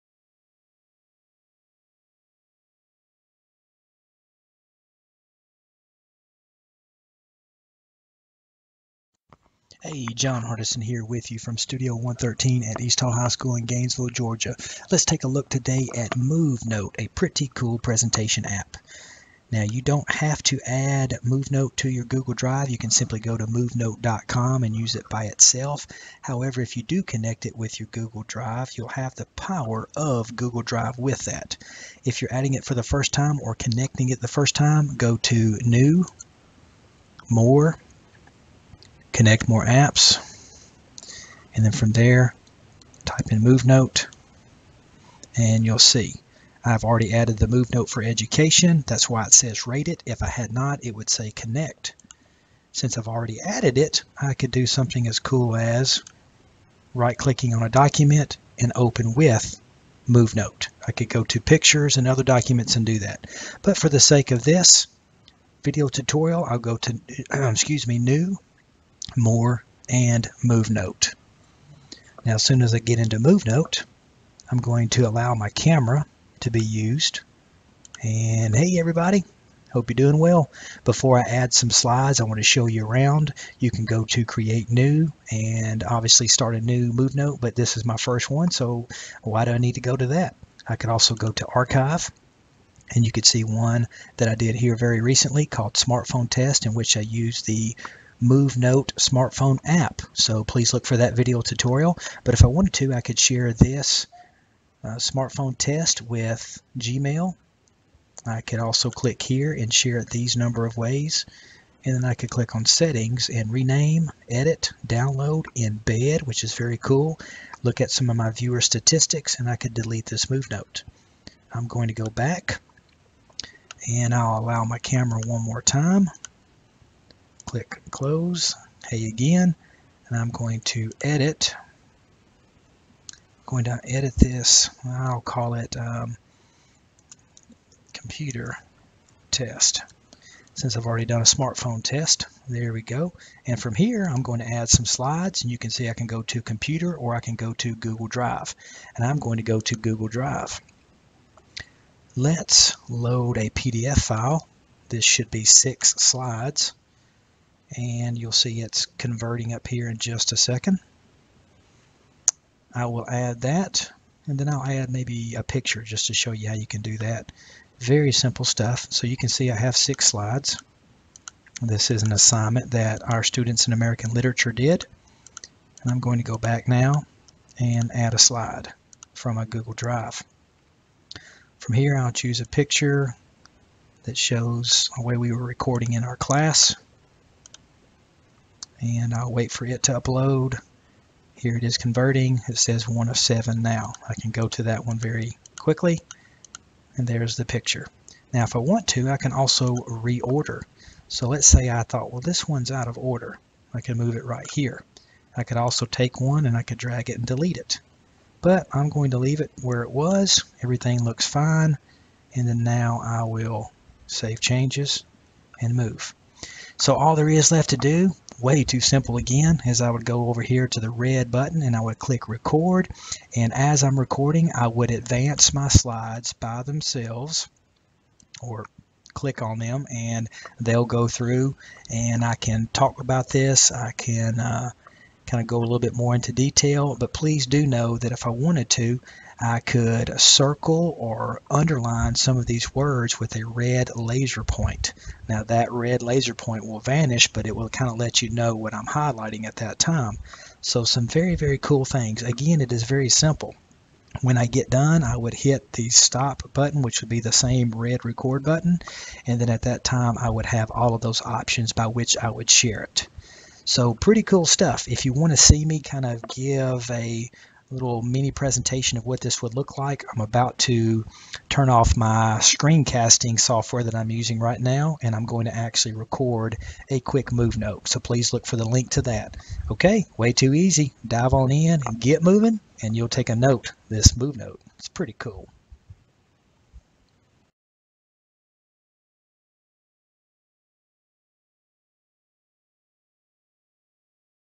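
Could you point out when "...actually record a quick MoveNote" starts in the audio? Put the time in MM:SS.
04:35.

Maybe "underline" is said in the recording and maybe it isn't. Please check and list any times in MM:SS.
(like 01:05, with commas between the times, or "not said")
04:01.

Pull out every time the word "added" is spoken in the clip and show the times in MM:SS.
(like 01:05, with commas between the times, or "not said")
00:47, 00:53.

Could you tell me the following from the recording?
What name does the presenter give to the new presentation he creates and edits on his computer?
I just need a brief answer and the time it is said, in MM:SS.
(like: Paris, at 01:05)
computer test, at 02:17.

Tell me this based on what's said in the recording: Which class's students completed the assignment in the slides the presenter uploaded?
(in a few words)
American literature.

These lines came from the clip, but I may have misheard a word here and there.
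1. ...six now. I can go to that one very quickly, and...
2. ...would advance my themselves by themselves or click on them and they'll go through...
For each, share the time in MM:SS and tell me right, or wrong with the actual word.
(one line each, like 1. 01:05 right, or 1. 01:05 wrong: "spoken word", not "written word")
1. 03:13 wrong: "seven", not "six"
2. 03:44 wrong: "slides", not "themselves".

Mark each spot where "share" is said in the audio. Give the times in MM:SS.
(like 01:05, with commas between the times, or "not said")
01:43, 01:49, 04:22.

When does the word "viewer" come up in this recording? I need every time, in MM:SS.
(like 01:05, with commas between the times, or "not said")
01:58.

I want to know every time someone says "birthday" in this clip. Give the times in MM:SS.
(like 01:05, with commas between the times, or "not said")
not said.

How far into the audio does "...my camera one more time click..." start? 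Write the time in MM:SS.
02:04.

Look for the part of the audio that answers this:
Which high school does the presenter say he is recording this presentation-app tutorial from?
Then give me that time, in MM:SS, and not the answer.
00:12.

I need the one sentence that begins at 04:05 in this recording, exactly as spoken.
Now that red laser point will vanish, but it will kind of let you know what I'm highlighting at that time.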